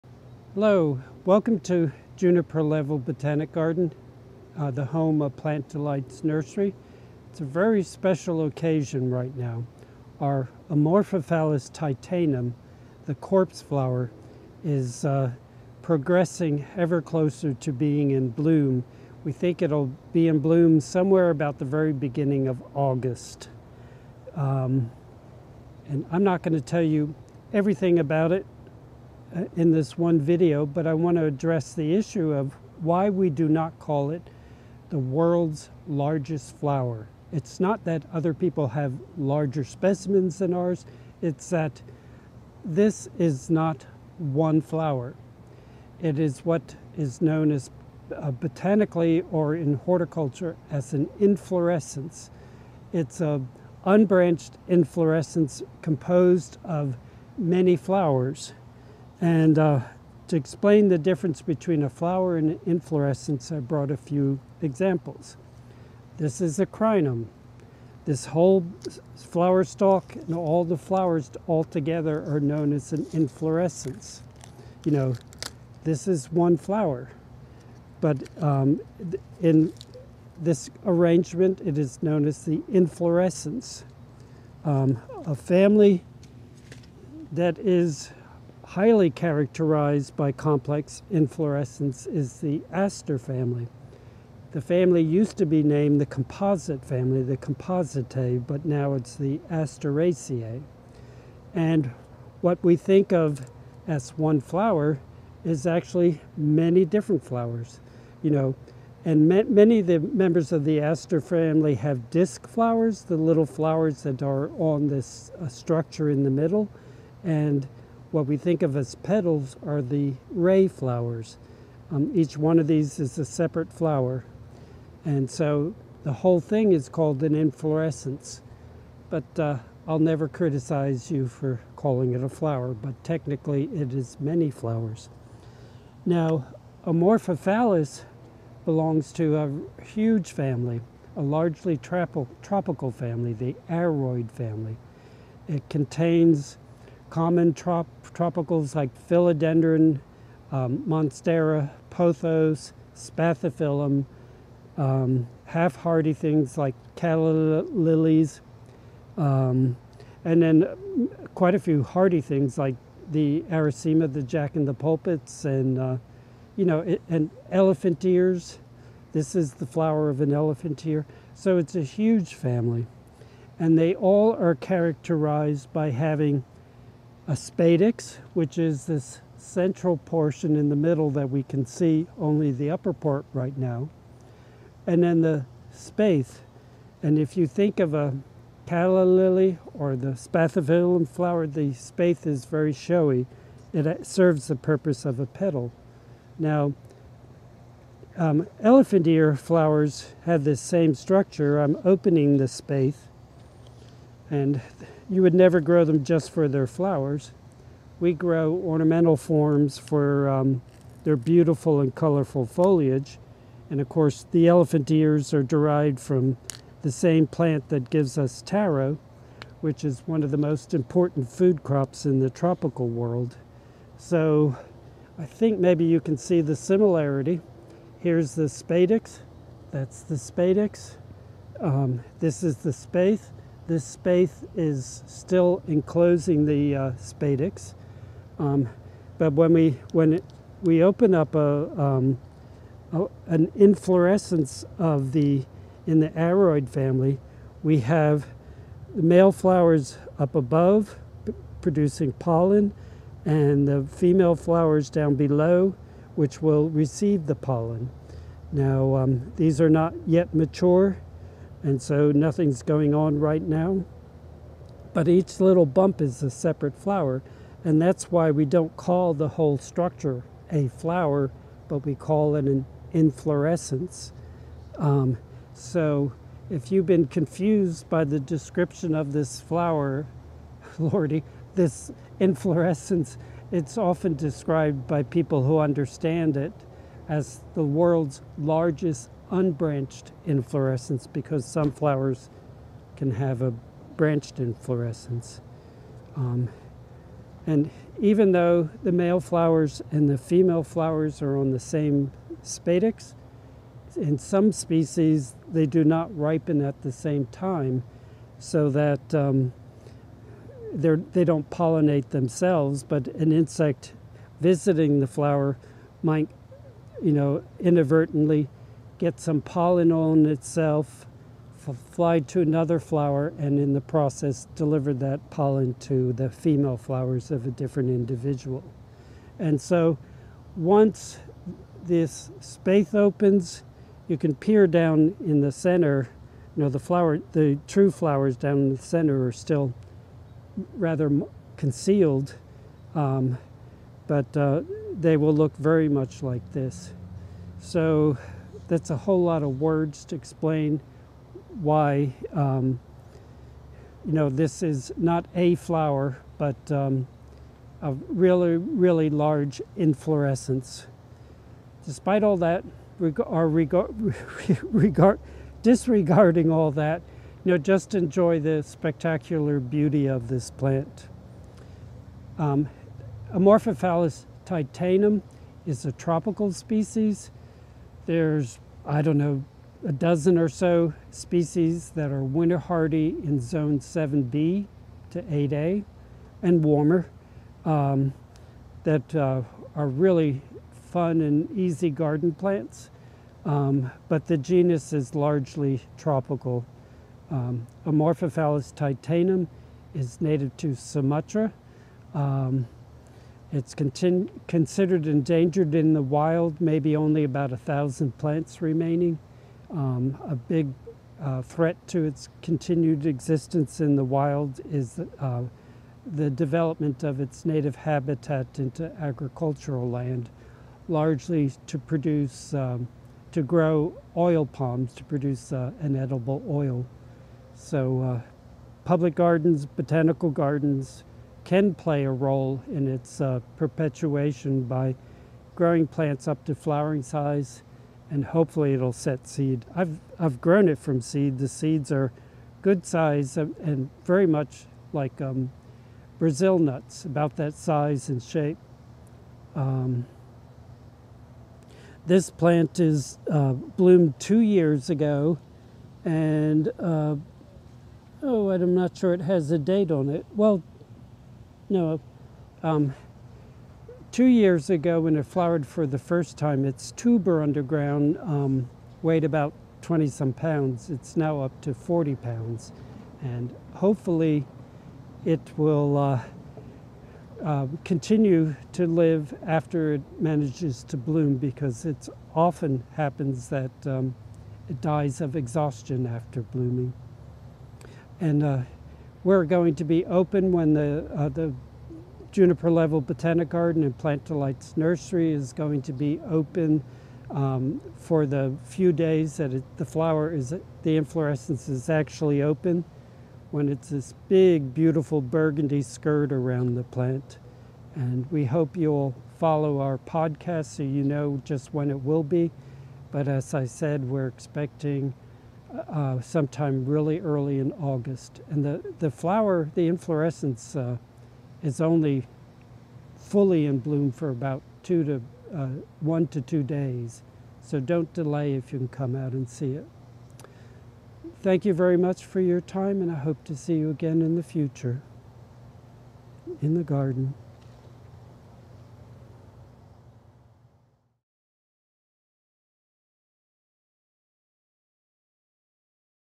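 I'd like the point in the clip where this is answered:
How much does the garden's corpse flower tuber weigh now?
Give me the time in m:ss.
7:51.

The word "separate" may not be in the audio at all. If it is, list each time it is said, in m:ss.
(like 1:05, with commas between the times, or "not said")
2:03, 4:26.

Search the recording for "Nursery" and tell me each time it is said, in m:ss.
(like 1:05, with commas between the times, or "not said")
0:06, 8:14.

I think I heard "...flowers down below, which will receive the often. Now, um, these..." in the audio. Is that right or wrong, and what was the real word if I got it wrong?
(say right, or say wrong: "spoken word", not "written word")
wrong: "pollen", not "often".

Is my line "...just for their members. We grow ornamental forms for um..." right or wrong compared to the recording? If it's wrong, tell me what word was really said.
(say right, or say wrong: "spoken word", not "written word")
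wrong: "flowers", not "members".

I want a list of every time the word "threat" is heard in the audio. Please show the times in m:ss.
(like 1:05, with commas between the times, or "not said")
6:51.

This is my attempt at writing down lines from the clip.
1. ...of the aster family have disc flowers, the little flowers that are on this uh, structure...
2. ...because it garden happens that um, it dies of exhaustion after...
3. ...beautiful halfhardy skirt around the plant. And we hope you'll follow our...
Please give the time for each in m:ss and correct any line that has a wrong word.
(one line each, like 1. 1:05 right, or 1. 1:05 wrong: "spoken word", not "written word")
1. 1:50 right
2. 8:01 wrong: "often", not "garden"
3. 8:24 wrong: "burgundy", not "halfhardy".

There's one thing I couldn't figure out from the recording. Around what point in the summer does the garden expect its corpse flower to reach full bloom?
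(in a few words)
Beginning of August.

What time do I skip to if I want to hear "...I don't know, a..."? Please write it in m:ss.
6:18.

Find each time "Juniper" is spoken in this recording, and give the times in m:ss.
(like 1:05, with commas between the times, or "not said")
0:02, 8:12.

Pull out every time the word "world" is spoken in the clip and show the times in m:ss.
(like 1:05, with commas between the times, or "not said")
0:34, 3:42, 4:47.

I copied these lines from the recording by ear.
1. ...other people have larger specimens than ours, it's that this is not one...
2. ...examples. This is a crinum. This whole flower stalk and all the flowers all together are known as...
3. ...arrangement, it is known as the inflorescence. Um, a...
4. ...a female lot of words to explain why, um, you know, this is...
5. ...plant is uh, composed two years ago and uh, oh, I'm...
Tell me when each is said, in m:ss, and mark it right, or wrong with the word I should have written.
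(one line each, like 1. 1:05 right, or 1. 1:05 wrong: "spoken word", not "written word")
1. 0:38 right
2. 1:04 right
3. 1:20 right
4. 5:48 wrong: "whole", not "female"
5. 7:32 wrong: "bloomed", not "composed".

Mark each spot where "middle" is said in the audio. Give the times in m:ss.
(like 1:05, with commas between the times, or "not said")
1:56, 3:00.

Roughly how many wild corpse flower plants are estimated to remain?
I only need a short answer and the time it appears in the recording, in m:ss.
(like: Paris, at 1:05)
About 1,000, at 6:47.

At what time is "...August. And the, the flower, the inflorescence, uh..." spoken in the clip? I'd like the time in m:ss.
8:37.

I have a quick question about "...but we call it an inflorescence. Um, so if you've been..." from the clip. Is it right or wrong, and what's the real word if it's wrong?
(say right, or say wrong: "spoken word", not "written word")
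right.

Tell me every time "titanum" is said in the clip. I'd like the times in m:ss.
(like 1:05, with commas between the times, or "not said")
0:11, 6:14, 6:38.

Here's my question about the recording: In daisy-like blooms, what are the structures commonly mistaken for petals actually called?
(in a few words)
Ray flowers.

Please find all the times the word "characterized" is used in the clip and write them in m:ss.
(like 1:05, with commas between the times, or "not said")
1:29, 2:54.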